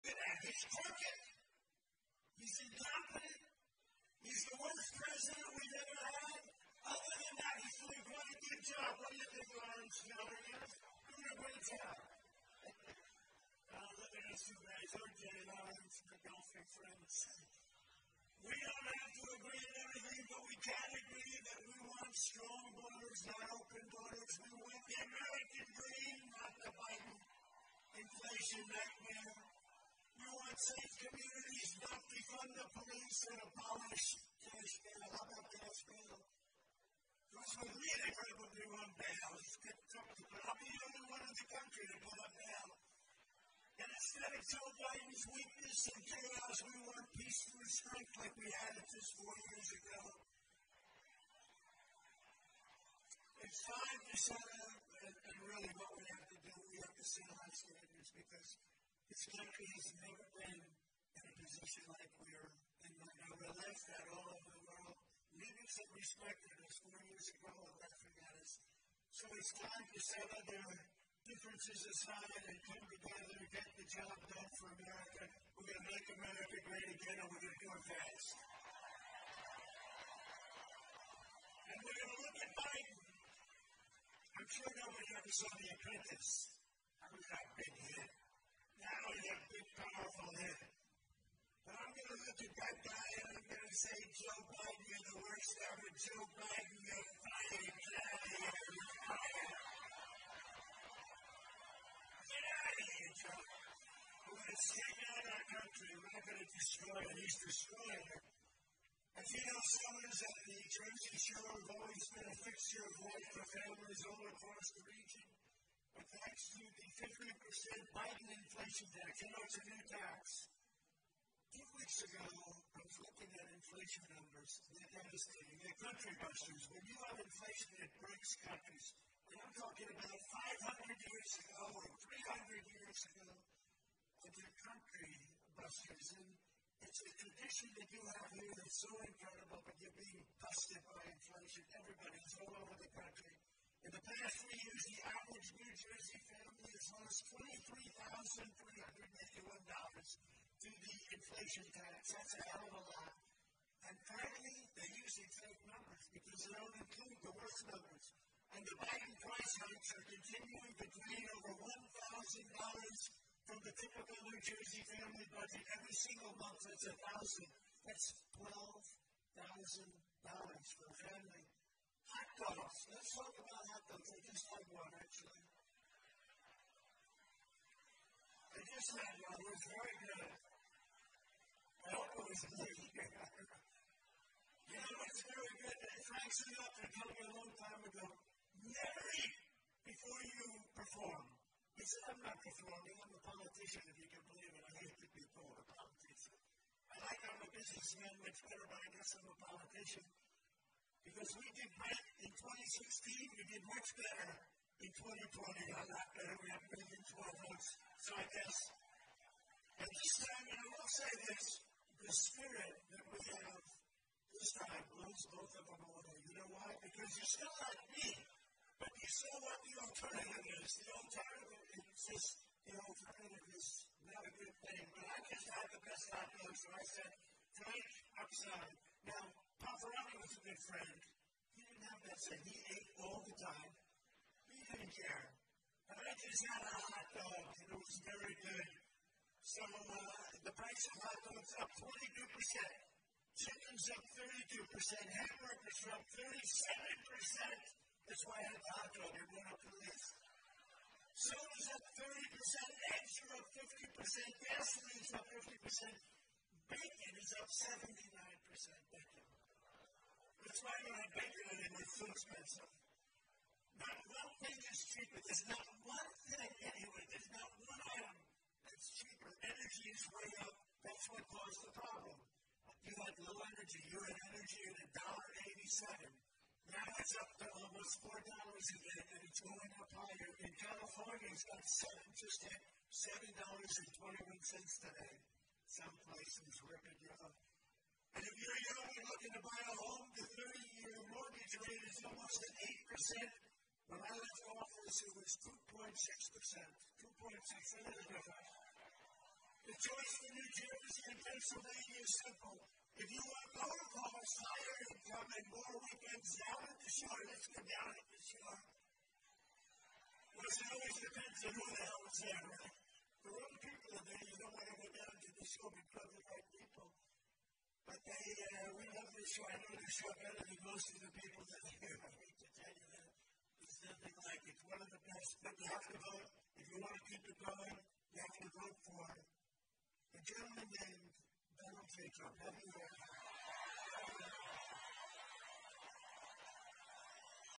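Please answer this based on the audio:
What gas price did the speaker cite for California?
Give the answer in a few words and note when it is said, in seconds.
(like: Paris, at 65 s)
$7.21, at 281 s.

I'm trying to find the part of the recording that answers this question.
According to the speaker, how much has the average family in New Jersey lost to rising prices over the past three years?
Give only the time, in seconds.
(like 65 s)
147 s.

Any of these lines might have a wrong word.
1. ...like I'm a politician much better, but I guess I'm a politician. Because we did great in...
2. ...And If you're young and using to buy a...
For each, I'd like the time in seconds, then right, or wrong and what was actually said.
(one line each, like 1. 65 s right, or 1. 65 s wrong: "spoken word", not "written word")
1. 196 s wrong: "businessman", not "politician"
2. 287 s wrong: "looking", not "using".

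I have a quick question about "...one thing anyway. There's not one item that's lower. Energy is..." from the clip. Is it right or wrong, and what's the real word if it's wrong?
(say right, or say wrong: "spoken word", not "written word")
wrong: "cheaper", not "lower".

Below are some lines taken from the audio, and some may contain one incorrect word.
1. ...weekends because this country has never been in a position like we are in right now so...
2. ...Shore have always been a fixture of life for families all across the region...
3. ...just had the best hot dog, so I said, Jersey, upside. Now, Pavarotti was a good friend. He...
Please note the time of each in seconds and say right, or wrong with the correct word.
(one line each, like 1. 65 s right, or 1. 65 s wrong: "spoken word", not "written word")
1. 57 s wrong: "standards", not "weekends"
2. 111 s right
3. 225 s wrong: "Frank", not "Jersey".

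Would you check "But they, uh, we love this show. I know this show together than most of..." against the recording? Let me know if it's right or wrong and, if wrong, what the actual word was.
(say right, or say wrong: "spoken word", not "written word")
wrong: "better", not "together".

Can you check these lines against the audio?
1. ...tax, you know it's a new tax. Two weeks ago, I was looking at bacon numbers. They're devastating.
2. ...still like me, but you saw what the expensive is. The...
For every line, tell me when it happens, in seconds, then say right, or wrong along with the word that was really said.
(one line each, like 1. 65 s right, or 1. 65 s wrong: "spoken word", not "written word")
1. 118 s wrong: "inflation", not "bacon"
2. 217 s wrong: "alternative", not "expensive".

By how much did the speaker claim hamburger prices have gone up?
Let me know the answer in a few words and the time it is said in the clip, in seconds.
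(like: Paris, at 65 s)
37%, at 246 s.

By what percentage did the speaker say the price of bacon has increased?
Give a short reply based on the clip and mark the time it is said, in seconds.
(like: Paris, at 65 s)
79%, at 257 s.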